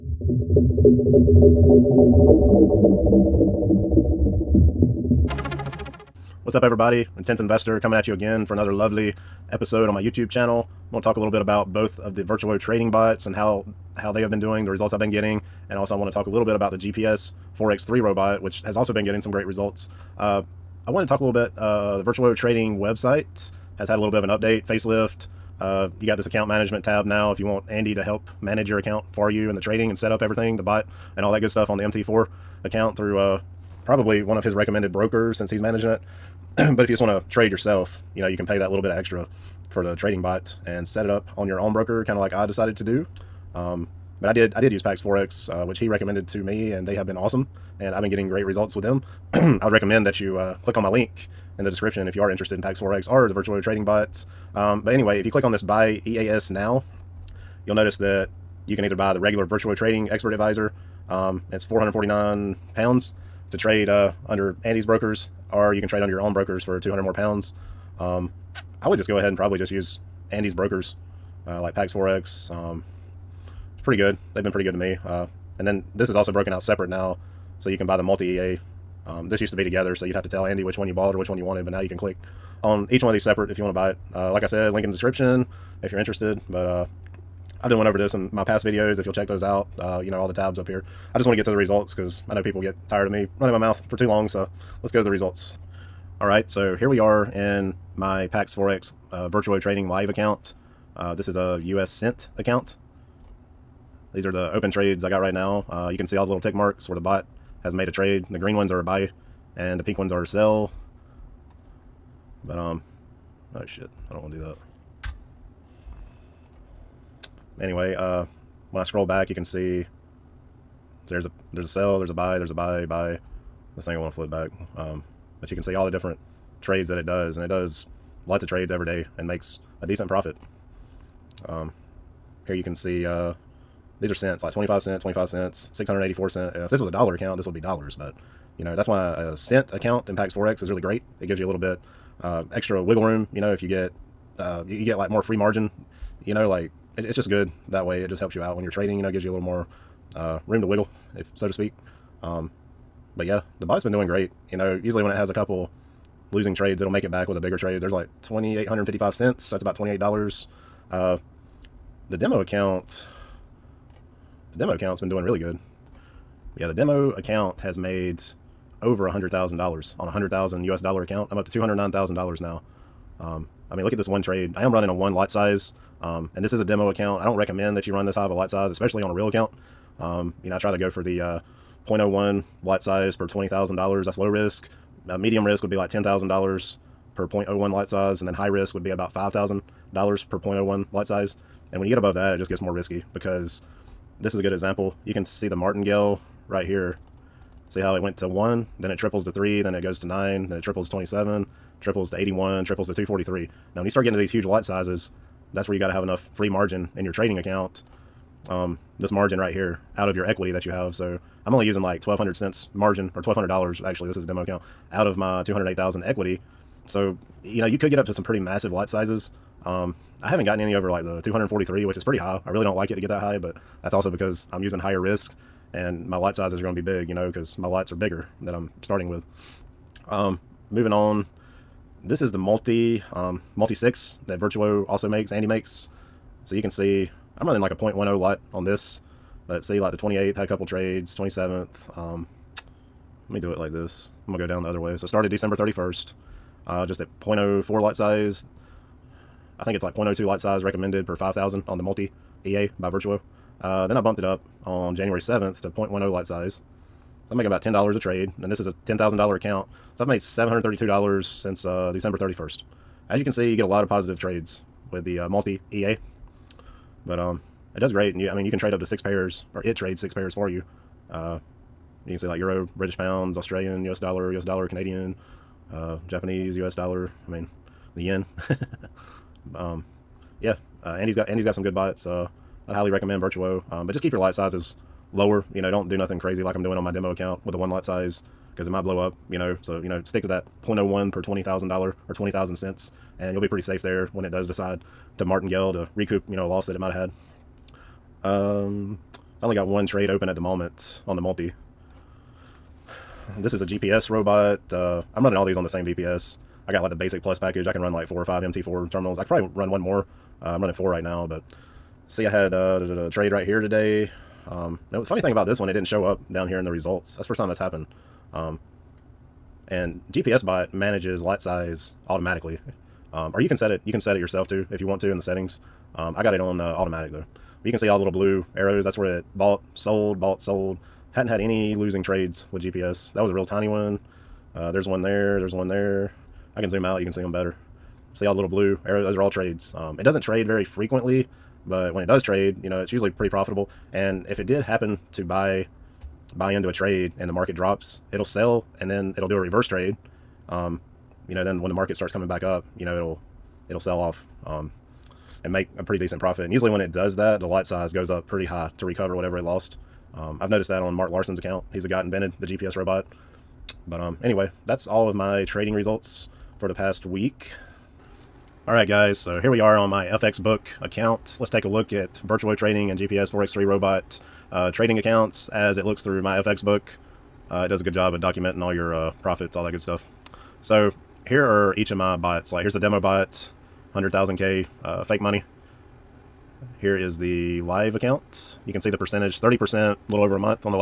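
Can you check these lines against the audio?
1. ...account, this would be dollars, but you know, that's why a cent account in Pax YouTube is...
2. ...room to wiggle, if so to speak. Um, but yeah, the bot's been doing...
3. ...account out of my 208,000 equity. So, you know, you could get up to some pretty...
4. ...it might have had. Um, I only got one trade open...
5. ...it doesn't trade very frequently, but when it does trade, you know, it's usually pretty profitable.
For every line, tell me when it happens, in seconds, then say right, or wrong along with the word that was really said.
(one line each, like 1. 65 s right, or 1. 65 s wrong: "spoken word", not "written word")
1. 137 s wrong: "Forex", not "YouTube"
2. 150 s right
3. 214 s right
4. 296 s right
5. 339 s right.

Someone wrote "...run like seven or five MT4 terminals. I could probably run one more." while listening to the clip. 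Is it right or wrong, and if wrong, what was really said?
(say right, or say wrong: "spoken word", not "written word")
wrong: "four", not "seven".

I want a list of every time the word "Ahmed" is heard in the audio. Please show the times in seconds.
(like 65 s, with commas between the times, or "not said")
not said.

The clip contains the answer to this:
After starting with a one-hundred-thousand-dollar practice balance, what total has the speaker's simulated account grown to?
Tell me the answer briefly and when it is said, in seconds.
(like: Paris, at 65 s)
$209,000, at 171 s.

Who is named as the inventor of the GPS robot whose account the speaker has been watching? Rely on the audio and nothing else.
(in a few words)
Mark Larsen.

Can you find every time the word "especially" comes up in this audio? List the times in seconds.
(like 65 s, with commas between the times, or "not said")
178 s.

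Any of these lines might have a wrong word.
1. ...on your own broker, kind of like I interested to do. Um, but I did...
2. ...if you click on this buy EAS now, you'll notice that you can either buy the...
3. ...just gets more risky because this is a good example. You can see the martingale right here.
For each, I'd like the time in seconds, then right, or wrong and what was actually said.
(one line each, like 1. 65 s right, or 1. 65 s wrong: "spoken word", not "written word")
1. 41 s wrong: "decided", not "interested"
2. 55 s right
3. 192 s right.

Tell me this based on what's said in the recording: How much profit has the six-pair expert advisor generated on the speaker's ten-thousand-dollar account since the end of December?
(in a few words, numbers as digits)
$732.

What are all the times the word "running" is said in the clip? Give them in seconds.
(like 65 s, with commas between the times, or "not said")
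93 s, 174 s, 237 s, 305 s, 310 s.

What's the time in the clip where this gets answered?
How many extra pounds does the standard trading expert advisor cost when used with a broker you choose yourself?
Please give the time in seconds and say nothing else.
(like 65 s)
66 s.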